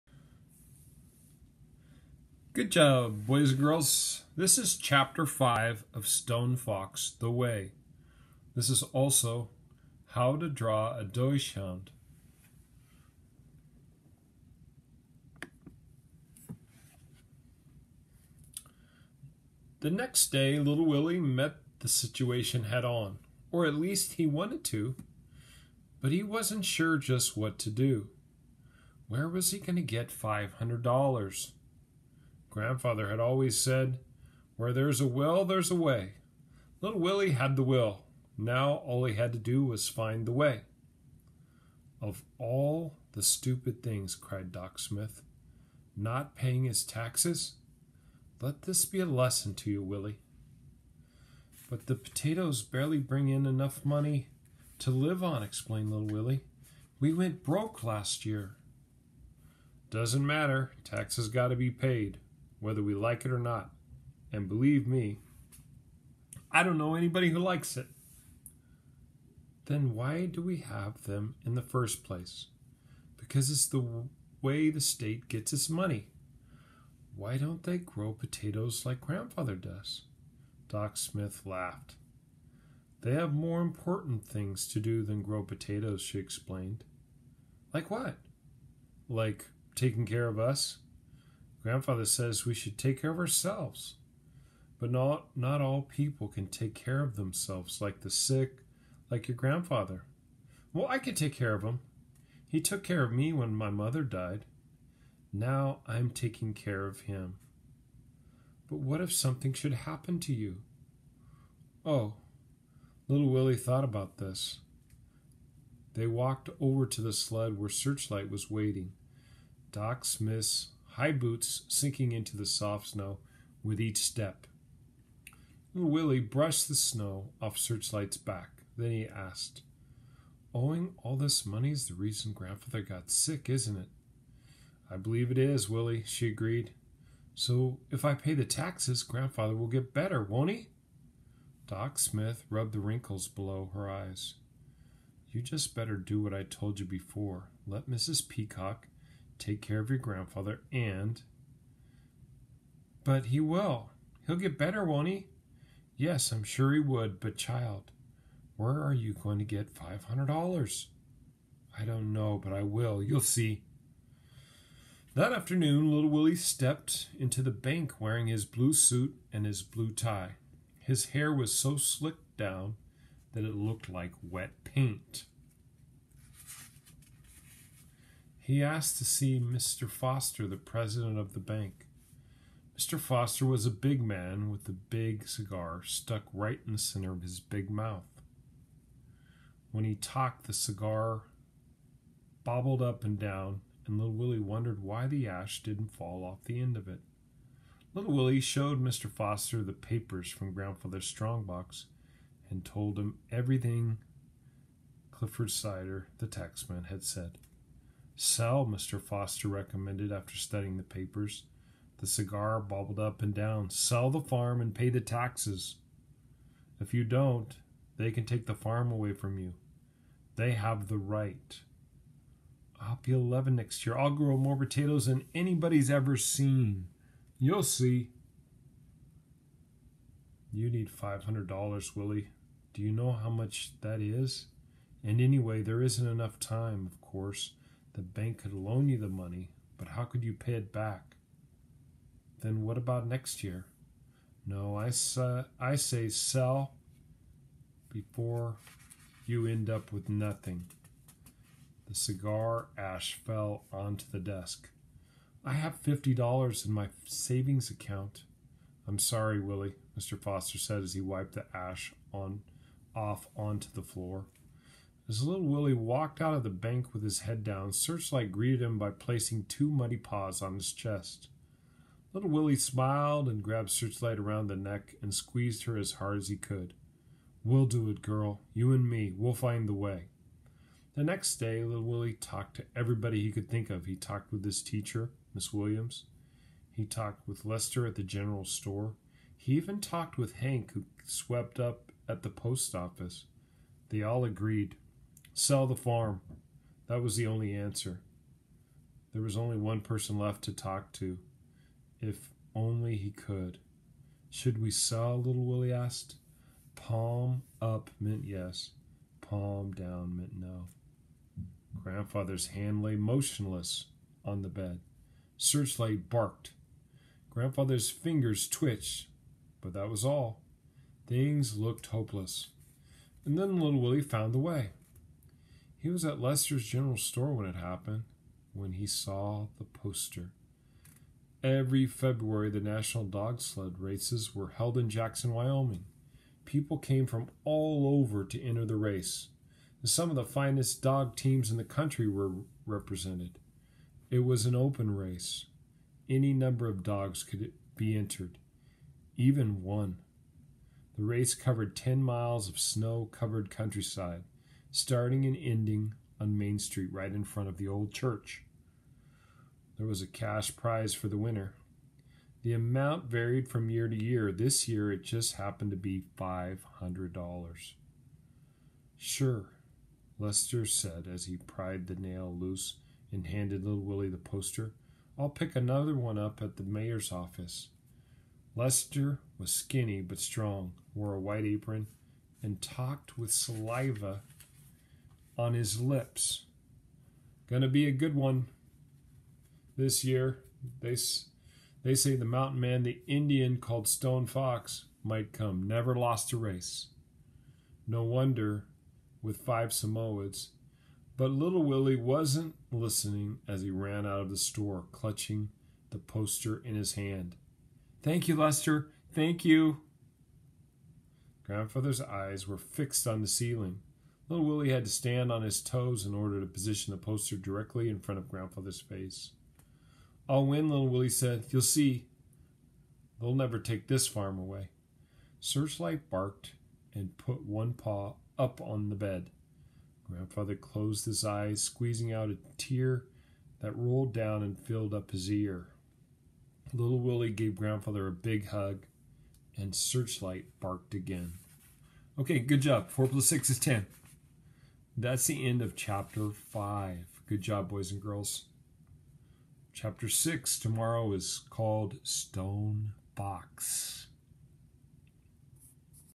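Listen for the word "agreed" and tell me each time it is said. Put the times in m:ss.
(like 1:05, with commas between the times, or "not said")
2:16, 4:54.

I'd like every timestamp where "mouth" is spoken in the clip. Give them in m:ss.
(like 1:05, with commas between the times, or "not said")
3:07.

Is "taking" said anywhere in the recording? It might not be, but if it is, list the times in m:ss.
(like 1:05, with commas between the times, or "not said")
1:29, 1:46.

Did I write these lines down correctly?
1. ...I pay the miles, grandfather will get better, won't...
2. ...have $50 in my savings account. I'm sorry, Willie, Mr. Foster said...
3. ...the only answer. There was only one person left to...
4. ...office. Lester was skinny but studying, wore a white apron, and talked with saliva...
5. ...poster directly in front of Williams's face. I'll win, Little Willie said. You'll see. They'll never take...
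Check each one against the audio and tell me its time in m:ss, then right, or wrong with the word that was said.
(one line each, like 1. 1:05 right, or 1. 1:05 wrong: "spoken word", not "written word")
1. 2:18 wrong: "taxes", not "miles"
2. 4:15 right
3. 4:57 right
4. 6:17 wrong: "strong", not "studying"
5. 6:56 wrong: "Grandfather", not "Williams".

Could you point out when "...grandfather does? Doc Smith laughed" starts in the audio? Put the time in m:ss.
1:19.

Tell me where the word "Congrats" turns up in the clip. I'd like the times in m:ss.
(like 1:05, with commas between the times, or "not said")
not said.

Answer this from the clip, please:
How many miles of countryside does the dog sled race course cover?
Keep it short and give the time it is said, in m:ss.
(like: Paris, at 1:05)
10 miles, at 5:51.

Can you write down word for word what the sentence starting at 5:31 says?
Every February, the national dog sled races were held in Jackson, Wyoming.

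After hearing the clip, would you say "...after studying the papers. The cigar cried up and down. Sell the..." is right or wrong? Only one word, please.
wrong.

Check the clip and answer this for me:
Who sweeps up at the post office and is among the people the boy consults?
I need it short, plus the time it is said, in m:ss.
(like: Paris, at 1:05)
Hank, at 4:50.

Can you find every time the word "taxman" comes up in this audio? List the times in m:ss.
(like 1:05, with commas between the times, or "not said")
3:26.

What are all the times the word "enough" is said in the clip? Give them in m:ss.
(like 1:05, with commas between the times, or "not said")
0:53, 3:56.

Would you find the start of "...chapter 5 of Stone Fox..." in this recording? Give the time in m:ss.
0:04.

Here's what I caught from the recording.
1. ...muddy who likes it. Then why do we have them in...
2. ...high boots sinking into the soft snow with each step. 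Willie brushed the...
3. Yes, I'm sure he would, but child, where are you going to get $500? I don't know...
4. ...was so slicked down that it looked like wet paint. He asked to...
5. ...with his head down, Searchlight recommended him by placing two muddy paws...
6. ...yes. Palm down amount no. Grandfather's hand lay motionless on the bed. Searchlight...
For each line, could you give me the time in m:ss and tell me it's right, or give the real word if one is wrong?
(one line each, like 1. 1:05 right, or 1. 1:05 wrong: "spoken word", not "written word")
1. 1:06 wrong: "anybody", not "muddy"
2. 2:00 right
3. 2:35 right
4. 2:51 right
5. 4:26 wrong: "greeted", not "recommended"
6. 5:08 wrong: "meant", not "amount".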